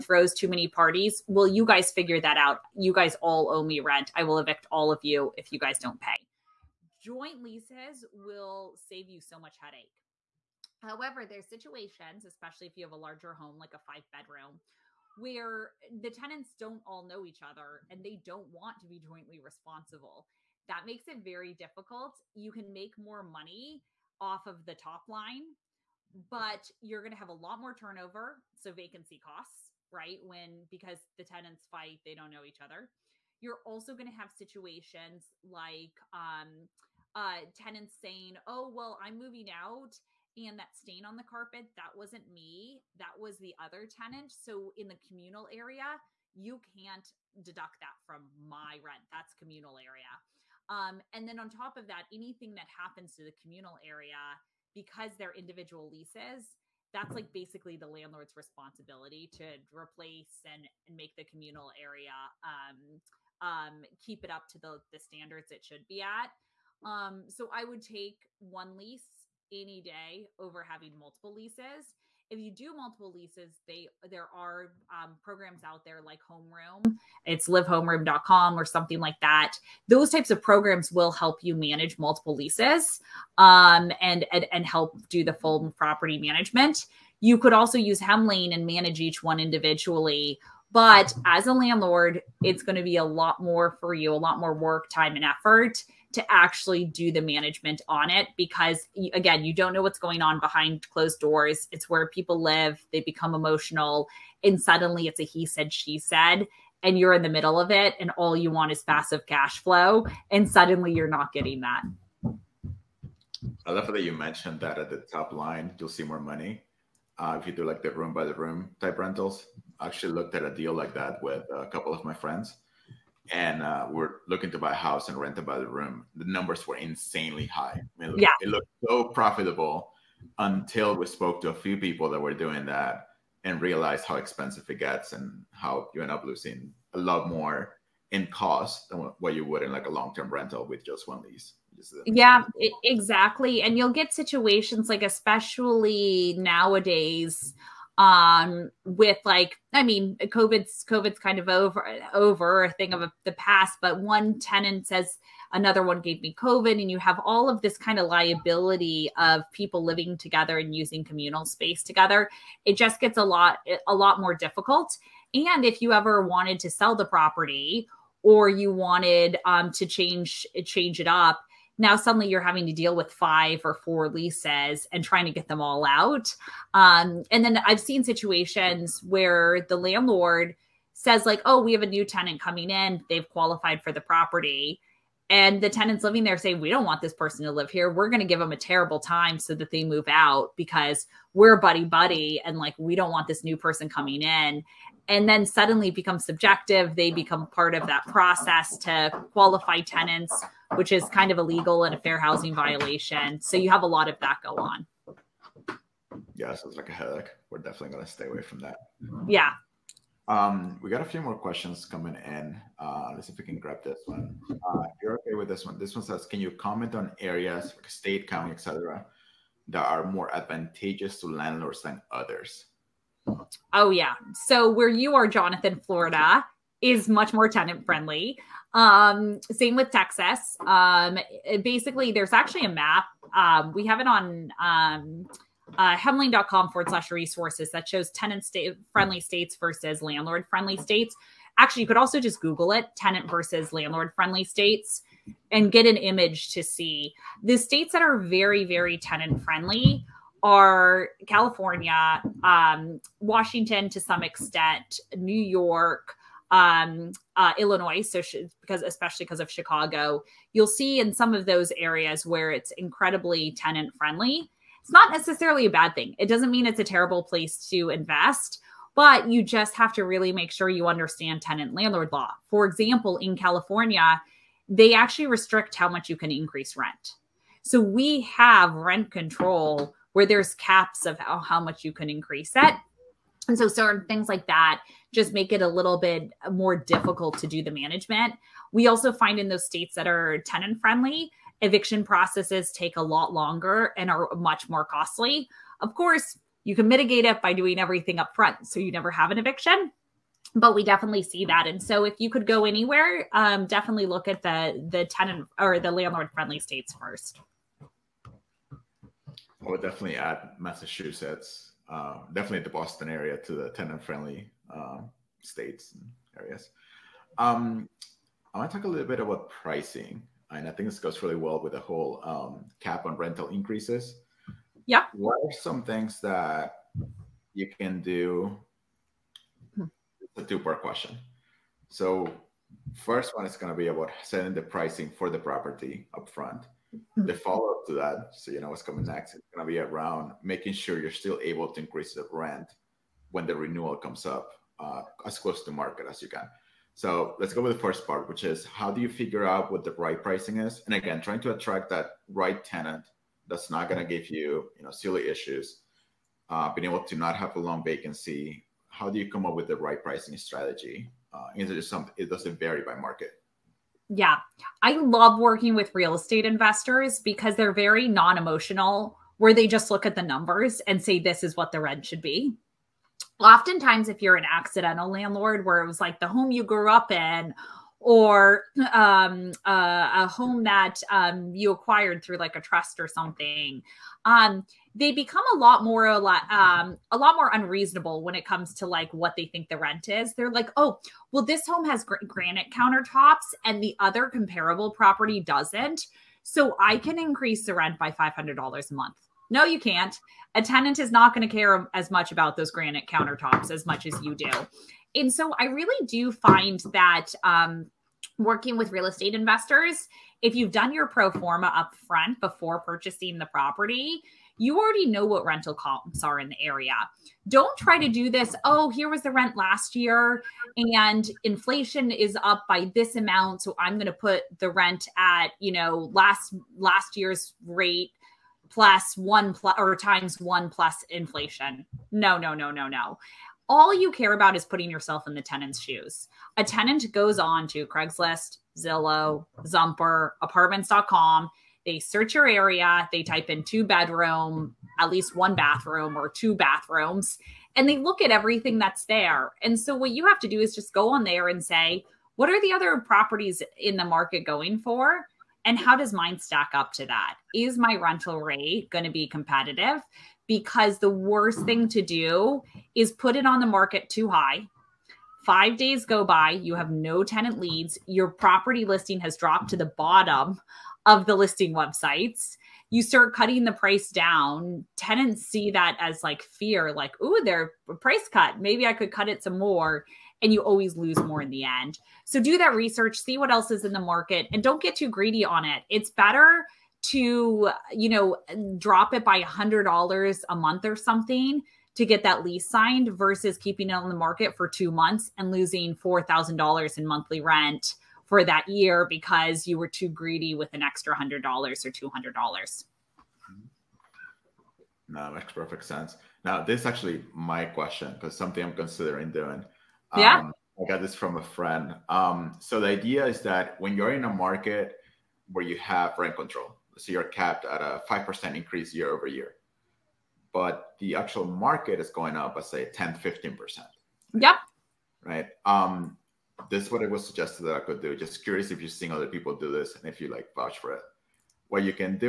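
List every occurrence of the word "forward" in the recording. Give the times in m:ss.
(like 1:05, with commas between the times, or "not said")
3:56.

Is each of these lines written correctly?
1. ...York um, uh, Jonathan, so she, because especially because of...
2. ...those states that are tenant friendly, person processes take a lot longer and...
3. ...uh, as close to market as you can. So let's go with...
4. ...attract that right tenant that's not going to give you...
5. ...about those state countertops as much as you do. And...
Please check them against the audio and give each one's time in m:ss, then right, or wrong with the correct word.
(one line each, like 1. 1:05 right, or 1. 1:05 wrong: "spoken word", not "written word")
1. 4:15 wrong: "Illinois", not "Jonathan"
2. 4:49 wrong: "eviction", not "person"
3. 5:44 right
4. 5:51 right
5. 6:42 wrong: "granite", not "state".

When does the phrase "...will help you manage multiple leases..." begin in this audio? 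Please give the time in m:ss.
1:20.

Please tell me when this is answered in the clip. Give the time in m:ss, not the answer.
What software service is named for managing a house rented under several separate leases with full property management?
1:16.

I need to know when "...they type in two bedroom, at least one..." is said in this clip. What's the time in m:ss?
7:23.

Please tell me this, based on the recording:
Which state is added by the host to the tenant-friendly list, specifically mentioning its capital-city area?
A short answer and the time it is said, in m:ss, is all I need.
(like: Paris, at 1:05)
Massachusetts, at 5:10.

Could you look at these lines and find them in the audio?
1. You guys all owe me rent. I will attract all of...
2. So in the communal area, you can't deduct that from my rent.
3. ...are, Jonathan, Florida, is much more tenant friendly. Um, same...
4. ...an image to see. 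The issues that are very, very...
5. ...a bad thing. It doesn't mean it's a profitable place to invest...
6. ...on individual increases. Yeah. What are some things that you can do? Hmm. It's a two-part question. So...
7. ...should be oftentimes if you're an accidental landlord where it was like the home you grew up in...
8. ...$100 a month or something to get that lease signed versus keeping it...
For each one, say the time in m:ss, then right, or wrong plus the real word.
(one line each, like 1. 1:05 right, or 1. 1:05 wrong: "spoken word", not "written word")
1. 0:02 wrong: "evict", not "attract"
2. 0:44 right
3. 3:45 right
4. 4:05 wrong: "states", not "issues"
5. 4:25 wrong: "terrible", not "profitable"
6. 5:23 wrong: "rental", not "individual"
7. 6:12 right
8. 8:09 right.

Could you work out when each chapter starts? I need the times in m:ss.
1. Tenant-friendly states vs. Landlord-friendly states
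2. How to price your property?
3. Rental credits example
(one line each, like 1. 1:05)
1. 3:35
2. 5:19
3. 8:28.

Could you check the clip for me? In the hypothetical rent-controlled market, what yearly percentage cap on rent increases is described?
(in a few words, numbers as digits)
5%.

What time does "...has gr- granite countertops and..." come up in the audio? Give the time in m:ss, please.
6:31.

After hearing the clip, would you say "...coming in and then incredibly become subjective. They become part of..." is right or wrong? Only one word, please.
wrong.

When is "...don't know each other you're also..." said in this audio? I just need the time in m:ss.
0:32.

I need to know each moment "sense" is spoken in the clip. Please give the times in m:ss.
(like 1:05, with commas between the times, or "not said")
8:25.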